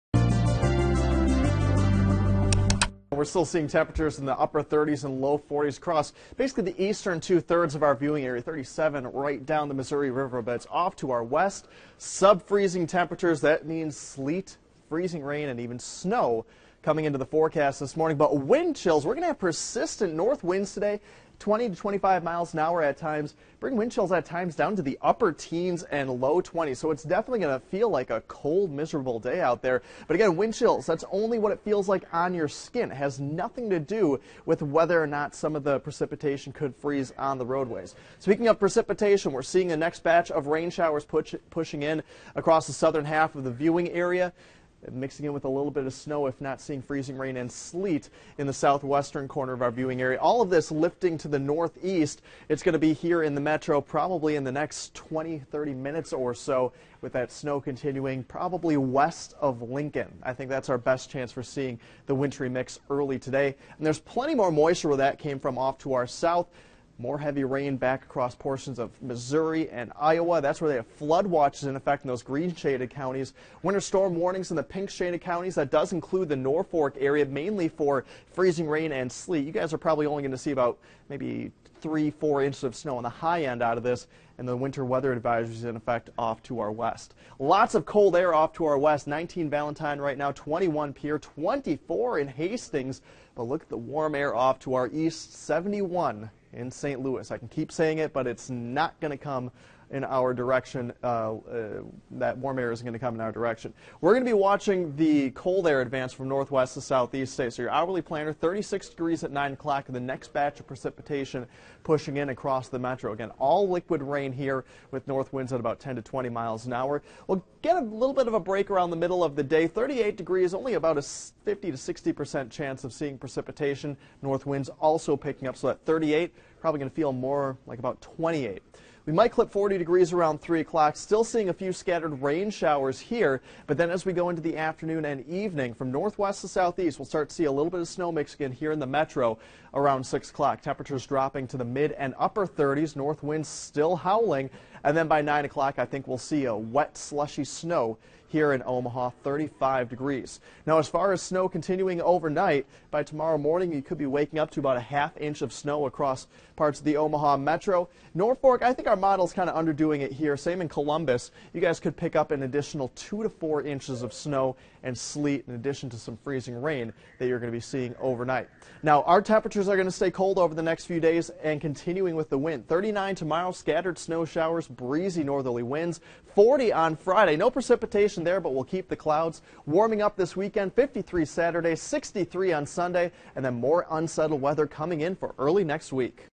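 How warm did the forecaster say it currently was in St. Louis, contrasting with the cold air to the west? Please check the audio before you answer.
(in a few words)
71.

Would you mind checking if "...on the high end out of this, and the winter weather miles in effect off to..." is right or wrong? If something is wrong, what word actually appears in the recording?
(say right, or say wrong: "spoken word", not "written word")
wrong: "advisories", not "miles".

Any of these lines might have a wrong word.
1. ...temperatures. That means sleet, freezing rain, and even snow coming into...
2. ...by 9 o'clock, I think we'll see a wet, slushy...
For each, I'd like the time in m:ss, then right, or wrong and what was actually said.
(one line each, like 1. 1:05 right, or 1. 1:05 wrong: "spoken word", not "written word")
1. 0:12 right
2. 2:25 right.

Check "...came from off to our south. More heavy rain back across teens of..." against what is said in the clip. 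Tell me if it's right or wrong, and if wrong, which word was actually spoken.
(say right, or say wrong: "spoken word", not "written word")
wrong: "portions", not "teens".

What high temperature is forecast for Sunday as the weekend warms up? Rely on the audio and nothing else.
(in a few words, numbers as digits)
63.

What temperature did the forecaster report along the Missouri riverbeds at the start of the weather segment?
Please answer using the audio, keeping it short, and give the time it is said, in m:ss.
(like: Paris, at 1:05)
37, at 0:08.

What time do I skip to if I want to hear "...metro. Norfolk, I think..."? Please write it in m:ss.
2:37.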